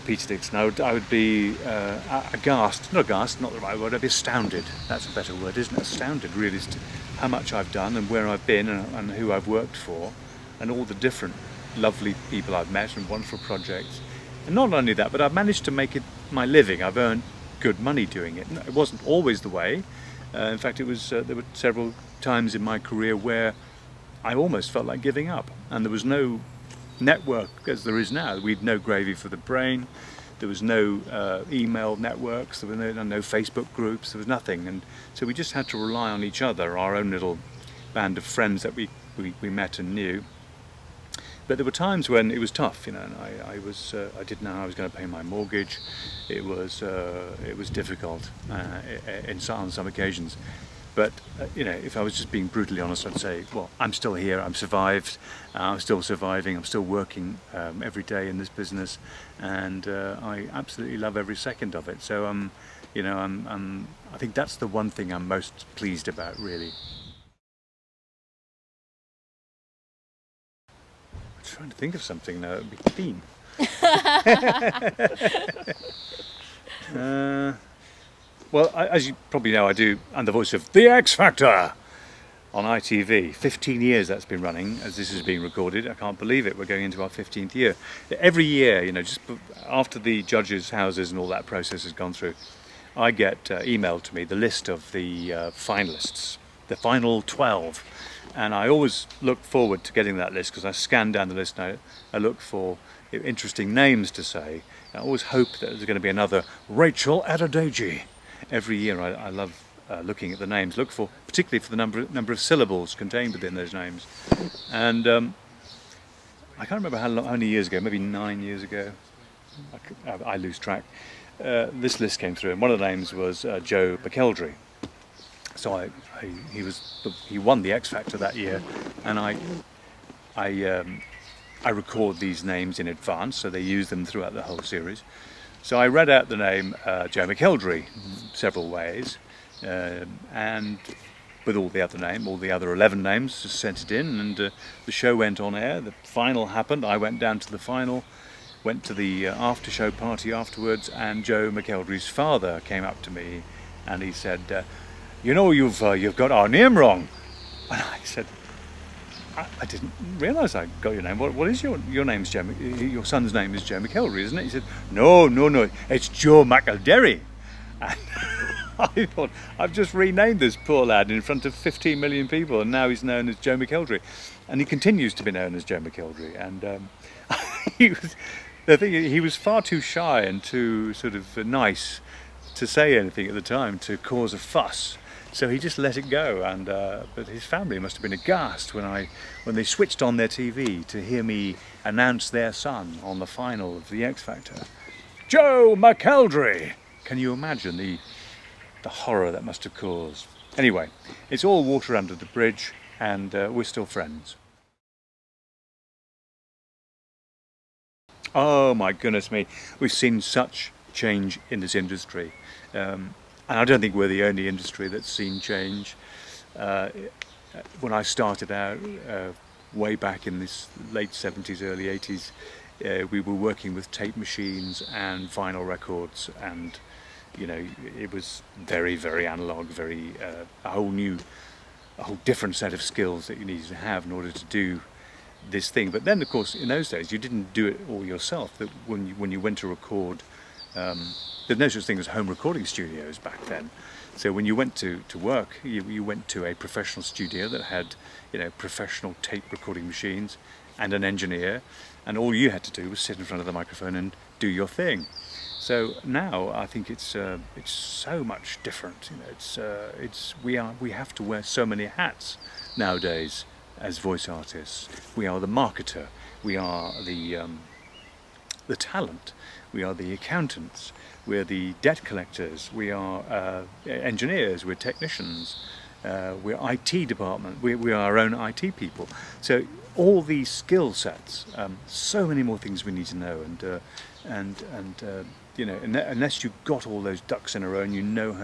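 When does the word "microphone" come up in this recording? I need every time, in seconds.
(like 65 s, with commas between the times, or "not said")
253 s.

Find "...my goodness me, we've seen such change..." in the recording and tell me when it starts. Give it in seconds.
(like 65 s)
208 s.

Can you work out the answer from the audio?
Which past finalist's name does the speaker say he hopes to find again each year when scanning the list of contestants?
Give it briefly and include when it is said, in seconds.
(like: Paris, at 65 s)
Rachel Adedeji, at 106 s.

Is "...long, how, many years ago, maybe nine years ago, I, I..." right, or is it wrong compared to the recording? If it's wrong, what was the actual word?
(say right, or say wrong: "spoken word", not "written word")
right.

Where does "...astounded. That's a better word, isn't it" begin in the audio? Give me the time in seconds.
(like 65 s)
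4 s.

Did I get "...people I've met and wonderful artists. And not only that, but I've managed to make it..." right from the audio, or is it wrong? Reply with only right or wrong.
wrong.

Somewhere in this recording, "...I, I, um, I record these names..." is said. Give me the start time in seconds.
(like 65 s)
129 s.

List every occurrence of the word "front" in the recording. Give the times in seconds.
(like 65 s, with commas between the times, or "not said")
171 s, 253 s.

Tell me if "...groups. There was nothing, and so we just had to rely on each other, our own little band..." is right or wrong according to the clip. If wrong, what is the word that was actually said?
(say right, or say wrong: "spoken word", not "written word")
right.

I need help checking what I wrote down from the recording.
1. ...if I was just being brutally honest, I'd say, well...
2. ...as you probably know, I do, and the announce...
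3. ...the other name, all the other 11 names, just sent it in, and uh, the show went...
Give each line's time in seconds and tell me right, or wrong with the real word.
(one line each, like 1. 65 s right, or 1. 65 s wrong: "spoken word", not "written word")
1. 51 s right
2. 78 s wrong: "voice", not "announce"
3. 141 s right.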